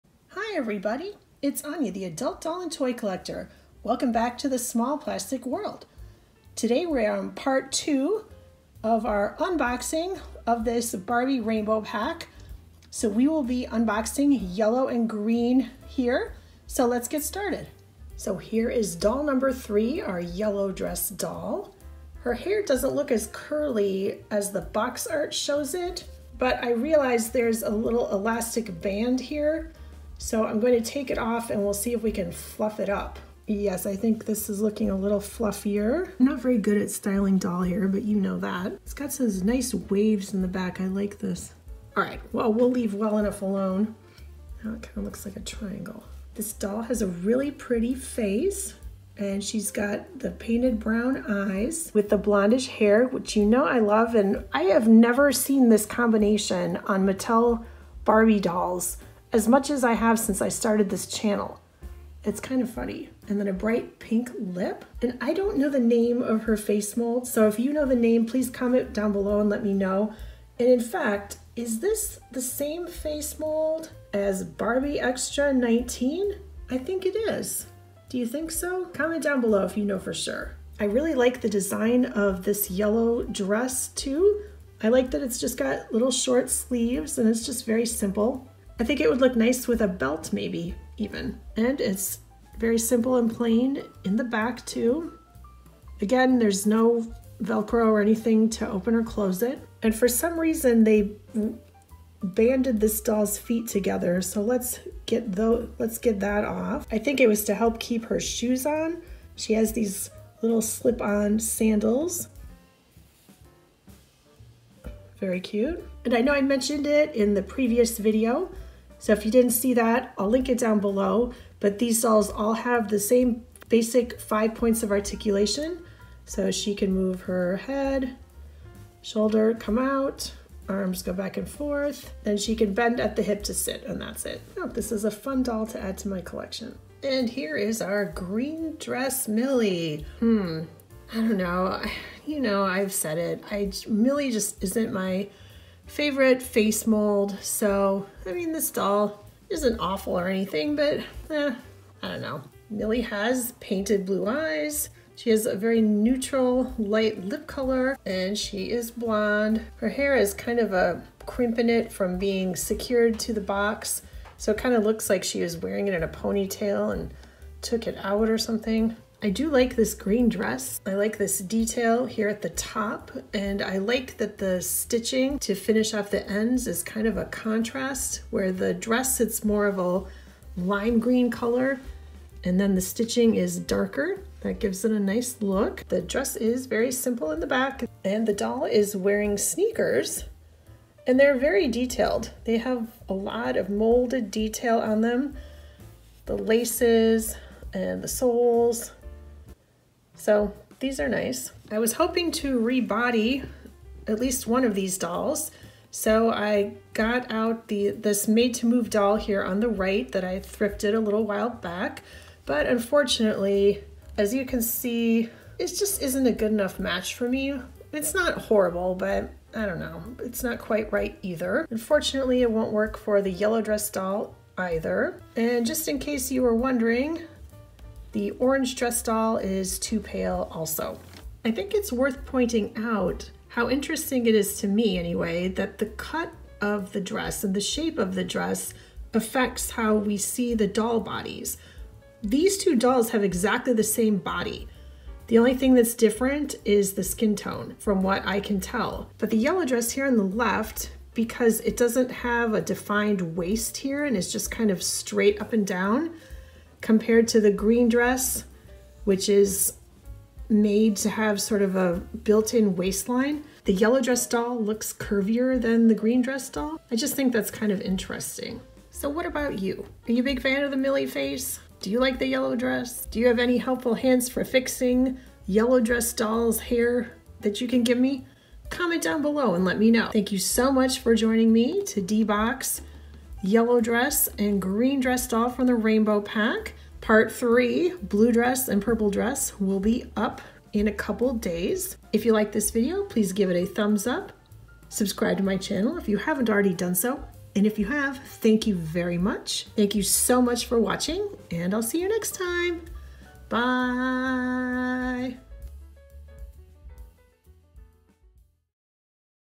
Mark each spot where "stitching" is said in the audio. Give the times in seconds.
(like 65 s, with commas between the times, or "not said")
174 s, 182 s.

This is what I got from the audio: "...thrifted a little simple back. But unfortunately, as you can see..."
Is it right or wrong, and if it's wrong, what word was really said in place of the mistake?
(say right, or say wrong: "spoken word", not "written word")
wrong: "while", not "simple".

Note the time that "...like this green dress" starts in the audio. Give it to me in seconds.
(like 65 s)
169 s.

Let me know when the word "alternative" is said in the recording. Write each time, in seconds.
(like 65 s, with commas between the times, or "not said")
not said.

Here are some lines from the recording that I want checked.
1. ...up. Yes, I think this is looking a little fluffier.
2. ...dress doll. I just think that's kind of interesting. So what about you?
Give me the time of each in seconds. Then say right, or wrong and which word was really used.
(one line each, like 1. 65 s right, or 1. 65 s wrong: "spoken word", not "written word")
1. 32 s right
2. 266 s right.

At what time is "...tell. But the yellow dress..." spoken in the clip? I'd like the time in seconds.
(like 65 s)
248 s.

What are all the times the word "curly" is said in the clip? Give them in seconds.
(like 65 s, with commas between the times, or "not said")
23 s.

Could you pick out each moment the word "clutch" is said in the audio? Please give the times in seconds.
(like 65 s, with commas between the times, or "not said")
not said.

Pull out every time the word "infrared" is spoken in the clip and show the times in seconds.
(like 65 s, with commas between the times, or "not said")
not said.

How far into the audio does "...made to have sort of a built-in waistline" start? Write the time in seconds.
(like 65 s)
260 s.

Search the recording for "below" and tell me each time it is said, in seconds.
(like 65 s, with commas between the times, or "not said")
69 s, 79 s, 120 s, 279 s.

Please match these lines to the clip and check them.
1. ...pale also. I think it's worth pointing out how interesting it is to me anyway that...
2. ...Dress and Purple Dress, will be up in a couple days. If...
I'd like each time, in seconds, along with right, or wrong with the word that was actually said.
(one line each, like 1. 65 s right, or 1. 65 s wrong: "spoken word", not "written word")
1. 230 s right
2. 288 s right.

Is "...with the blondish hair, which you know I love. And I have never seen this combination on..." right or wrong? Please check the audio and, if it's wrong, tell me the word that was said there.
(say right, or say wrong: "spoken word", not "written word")
right.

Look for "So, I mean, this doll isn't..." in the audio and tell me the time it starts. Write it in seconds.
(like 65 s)
147 s.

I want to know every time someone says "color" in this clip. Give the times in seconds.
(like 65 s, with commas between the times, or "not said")
157 s, 181 s.